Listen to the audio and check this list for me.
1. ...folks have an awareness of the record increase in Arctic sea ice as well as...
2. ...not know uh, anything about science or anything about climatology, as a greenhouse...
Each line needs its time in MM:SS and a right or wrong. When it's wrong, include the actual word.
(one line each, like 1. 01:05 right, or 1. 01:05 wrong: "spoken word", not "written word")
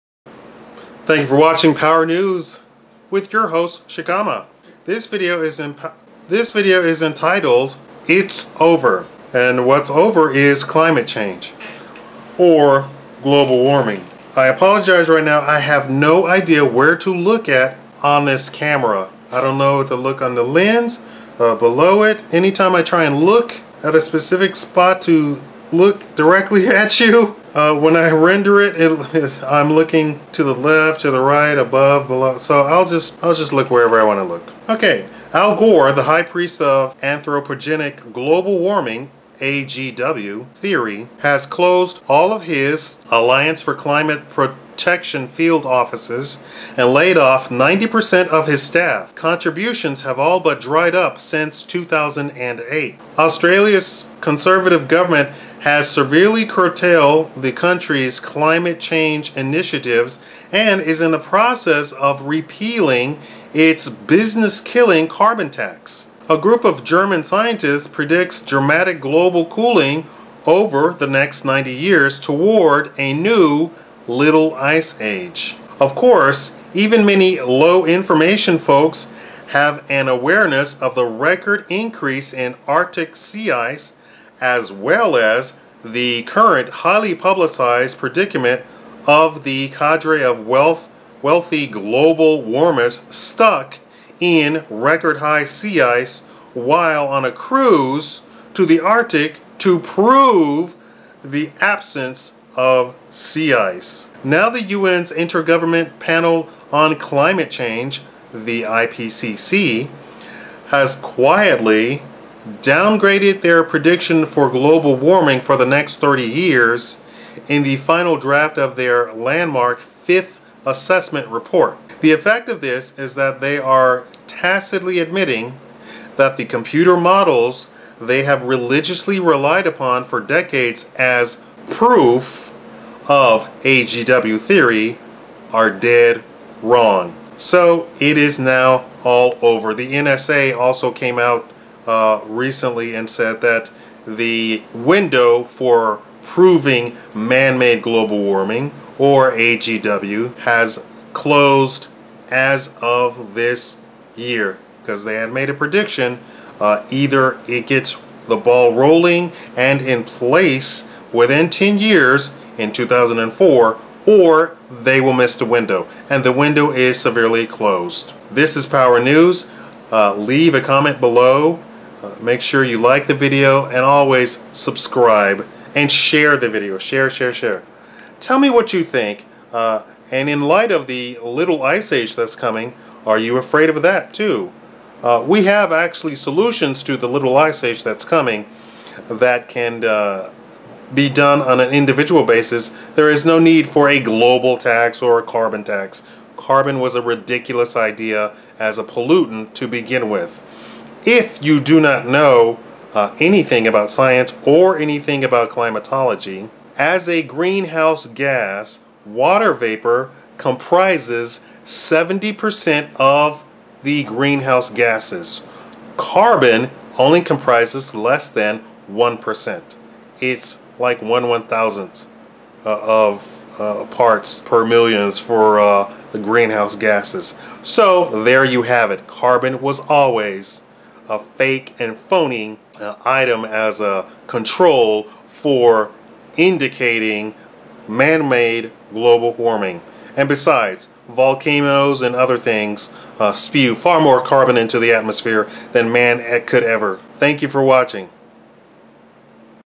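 1. 01:18 right
2. 03:21 right.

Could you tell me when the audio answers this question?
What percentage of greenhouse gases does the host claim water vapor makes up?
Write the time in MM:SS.
03:31.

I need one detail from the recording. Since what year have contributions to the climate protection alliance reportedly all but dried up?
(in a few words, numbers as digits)
2008.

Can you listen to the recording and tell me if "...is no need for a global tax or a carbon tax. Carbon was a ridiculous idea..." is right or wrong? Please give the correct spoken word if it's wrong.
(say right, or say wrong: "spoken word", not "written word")
right.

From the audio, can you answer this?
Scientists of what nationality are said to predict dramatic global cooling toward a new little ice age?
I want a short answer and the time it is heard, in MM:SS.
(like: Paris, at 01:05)
German, at 01:06.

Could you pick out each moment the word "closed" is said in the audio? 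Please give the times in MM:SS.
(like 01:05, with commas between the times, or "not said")
00:41, 02:31, 02:47.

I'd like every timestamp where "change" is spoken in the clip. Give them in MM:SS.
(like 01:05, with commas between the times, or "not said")
00:11, 00:58, 01:47.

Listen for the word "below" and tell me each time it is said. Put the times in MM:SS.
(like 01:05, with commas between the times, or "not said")
00:21, 00:32, 02:51.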